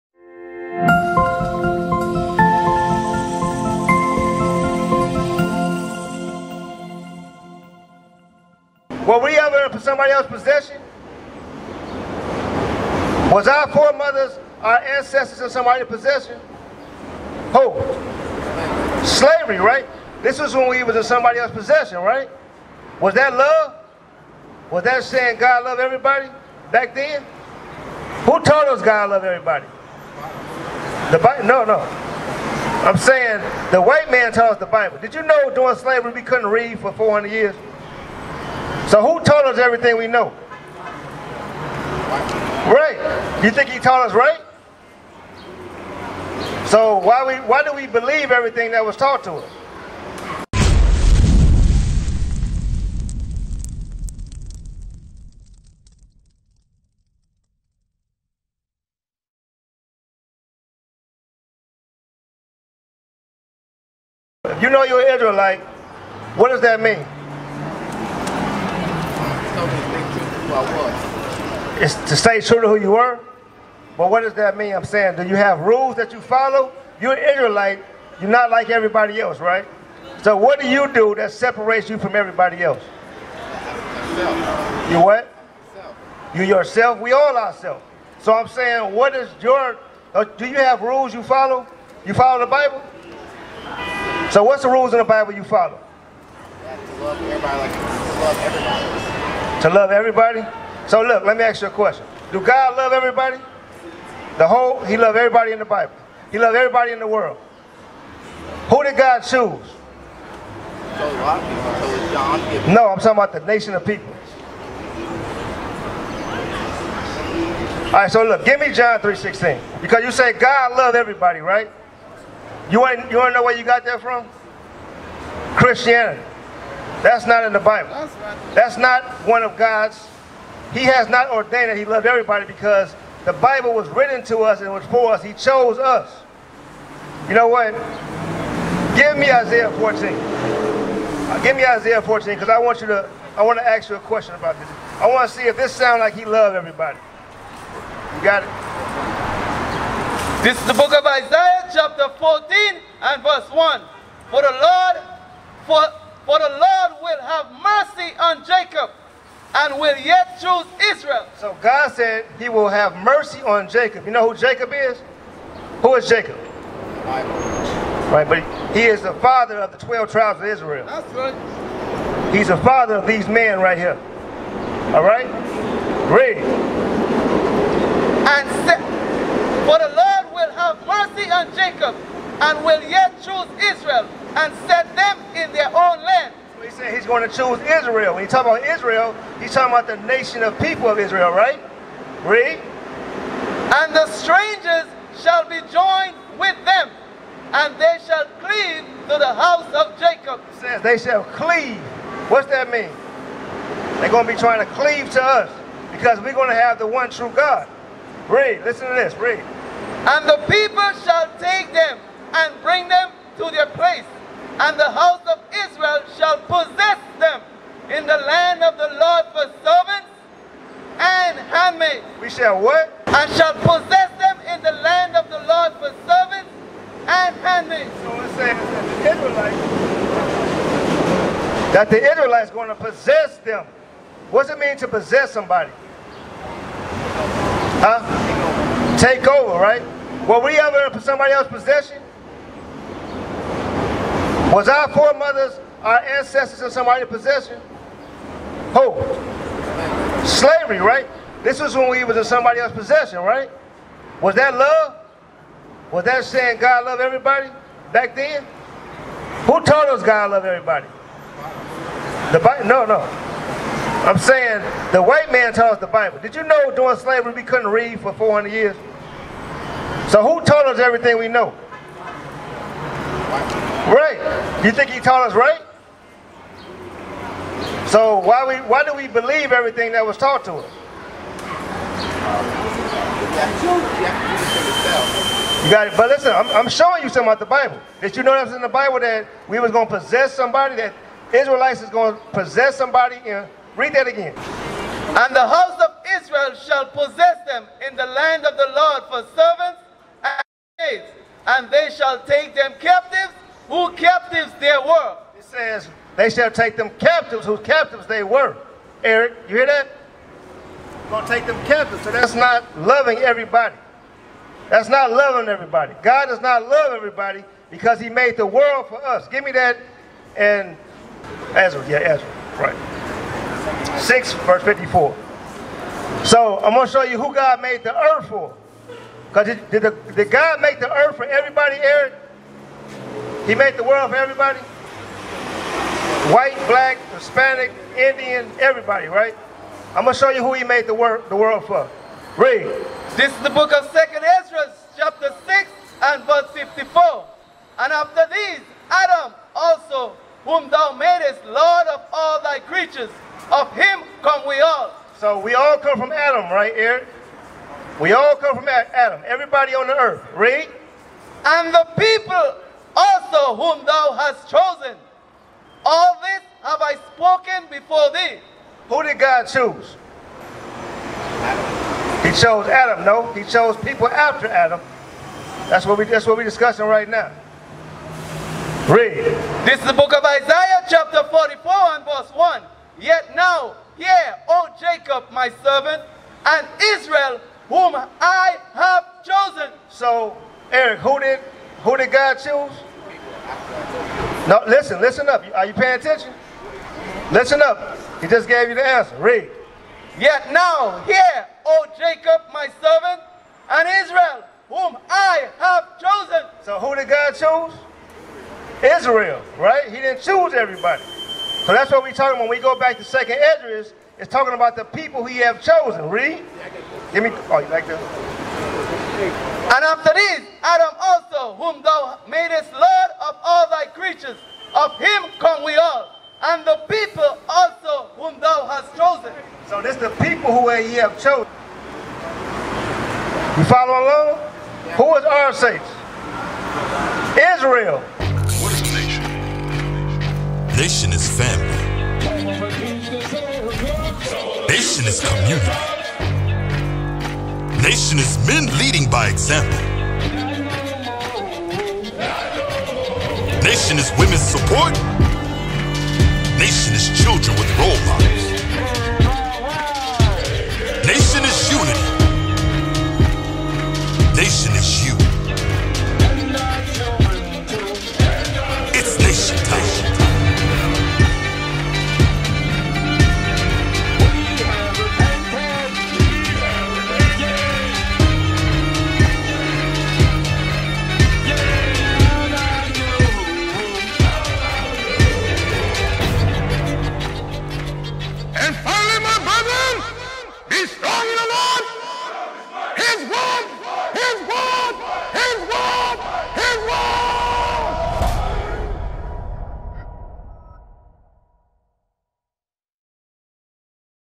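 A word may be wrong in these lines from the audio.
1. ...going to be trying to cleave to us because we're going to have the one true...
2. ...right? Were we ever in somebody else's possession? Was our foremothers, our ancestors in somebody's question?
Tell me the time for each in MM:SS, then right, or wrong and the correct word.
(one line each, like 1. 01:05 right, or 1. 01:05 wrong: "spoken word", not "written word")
1. 03:24 right
2. 03:59 wrong: "possession", not "question".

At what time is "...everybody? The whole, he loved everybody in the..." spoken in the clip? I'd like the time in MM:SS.
01:42.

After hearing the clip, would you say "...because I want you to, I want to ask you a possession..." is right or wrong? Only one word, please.
wrong.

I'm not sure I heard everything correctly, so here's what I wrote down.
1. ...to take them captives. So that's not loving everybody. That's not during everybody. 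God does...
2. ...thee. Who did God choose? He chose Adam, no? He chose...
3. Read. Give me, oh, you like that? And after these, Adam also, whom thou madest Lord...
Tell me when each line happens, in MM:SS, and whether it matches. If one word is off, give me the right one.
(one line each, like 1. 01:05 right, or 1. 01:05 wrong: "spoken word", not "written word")
1. 05:11 wrong: "loving", not "during"
2. 06:08 right
3. 06:56 right.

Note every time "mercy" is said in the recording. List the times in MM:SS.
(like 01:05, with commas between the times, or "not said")
02:37, 02:42, 03:00.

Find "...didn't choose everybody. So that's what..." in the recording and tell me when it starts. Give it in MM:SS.
06:49.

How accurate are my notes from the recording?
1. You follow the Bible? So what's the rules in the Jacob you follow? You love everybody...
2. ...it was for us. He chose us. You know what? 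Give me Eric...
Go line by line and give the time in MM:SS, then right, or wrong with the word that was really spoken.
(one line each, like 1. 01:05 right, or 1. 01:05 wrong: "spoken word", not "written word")
1. 01:32 wrong: "Bible", not "Jacob"
2. 02:14 wrong: "Isaiah", not "Eric".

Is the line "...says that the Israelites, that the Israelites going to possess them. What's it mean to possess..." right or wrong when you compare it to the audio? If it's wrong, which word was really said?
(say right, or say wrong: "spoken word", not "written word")
right.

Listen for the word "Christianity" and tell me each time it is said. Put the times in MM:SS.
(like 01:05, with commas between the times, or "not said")
02:05.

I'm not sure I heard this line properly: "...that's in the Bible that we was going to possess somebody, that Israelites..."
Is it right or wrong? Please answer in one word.
right.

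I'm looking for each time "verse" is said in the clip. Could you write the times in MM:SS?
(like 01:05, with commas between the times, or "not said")
02:33, 05:24, 05:46, 06:22.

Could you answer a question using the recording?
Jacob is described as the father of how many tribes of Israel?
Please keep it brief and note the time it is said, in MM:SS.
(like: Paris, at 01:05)
12, at 02:49.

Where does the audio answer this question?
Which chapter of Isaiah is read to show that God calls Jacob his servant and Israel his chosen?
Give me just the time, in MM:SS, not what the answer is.
06:21.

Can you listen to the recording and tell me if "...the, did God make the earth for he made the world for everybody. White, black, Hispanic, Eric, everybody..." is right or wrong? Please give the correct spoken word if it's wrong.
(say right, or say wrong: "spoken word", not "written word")
wrong: "Indian", not "Eric".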